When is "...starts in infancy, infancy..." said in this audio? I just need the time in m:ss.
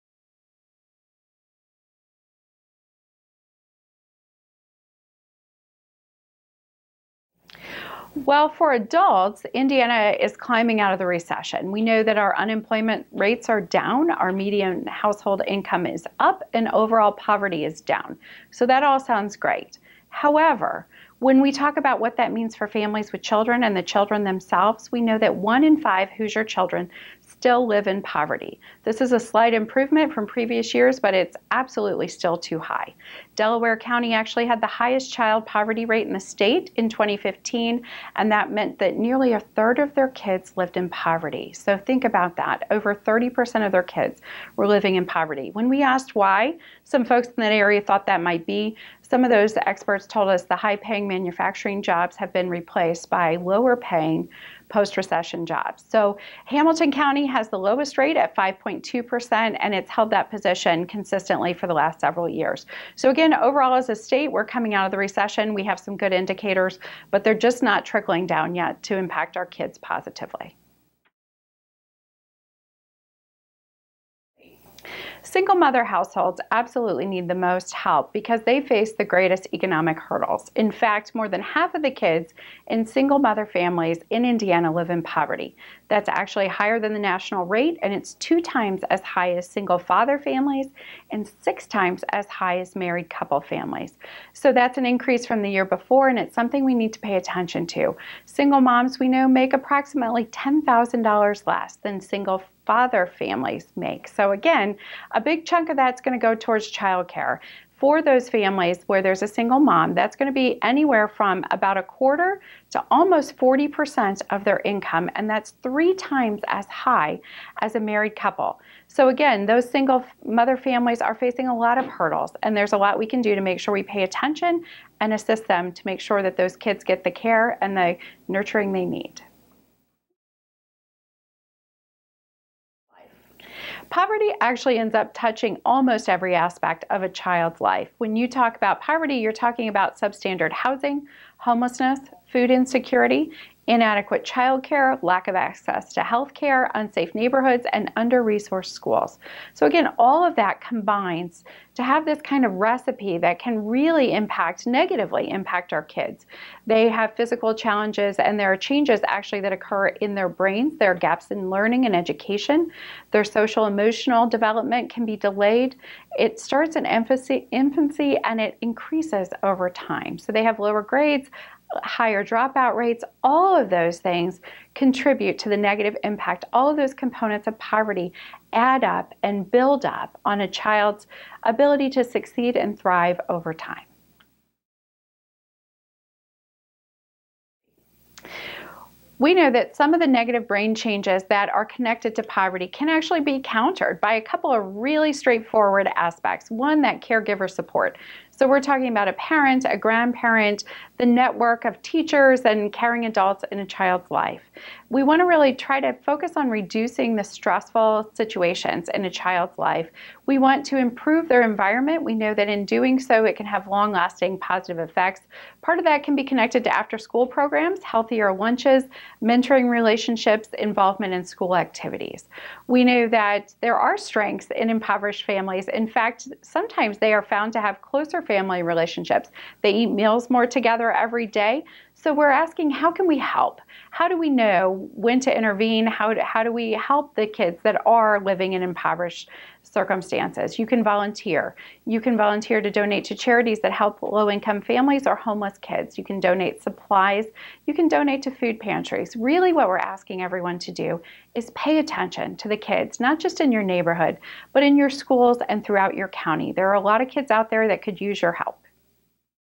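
2:46.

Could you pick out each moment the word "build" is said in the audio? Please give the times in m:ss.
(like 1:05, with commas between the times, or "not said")
2:59.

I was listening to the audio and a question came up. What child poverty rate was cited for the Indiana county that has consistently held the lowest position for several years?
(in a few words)
5.2%.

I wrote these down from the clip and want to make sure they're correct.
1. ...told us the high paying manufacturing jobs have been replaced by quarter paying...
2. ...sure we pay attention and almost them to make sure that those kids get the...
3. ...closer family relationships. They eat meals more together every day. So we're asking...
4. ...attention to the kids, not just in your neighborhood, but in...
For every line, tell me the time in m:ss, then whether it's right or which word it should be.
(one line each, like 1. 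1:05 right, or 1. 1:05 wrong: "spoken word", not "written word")
1. 0:50 wrong: "lower", not "quarter"
2. 2:03 wrong: "assist", not "almost"
3. 3:47 right
4. 4:11 right.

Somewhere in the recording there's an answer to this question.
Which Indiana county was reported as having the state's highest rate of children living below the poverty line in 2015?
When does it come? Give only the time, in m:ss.
0:33.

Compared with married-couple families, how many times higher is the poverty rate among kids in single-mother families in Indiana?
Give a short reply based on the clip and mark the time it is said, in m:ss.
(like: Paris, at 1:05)
6 times, at 1:31.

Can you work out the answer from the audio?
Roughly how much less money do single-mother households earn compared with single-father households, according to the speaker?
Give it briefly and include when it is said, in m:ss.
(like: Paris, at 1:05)
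$10,000, at 1:40.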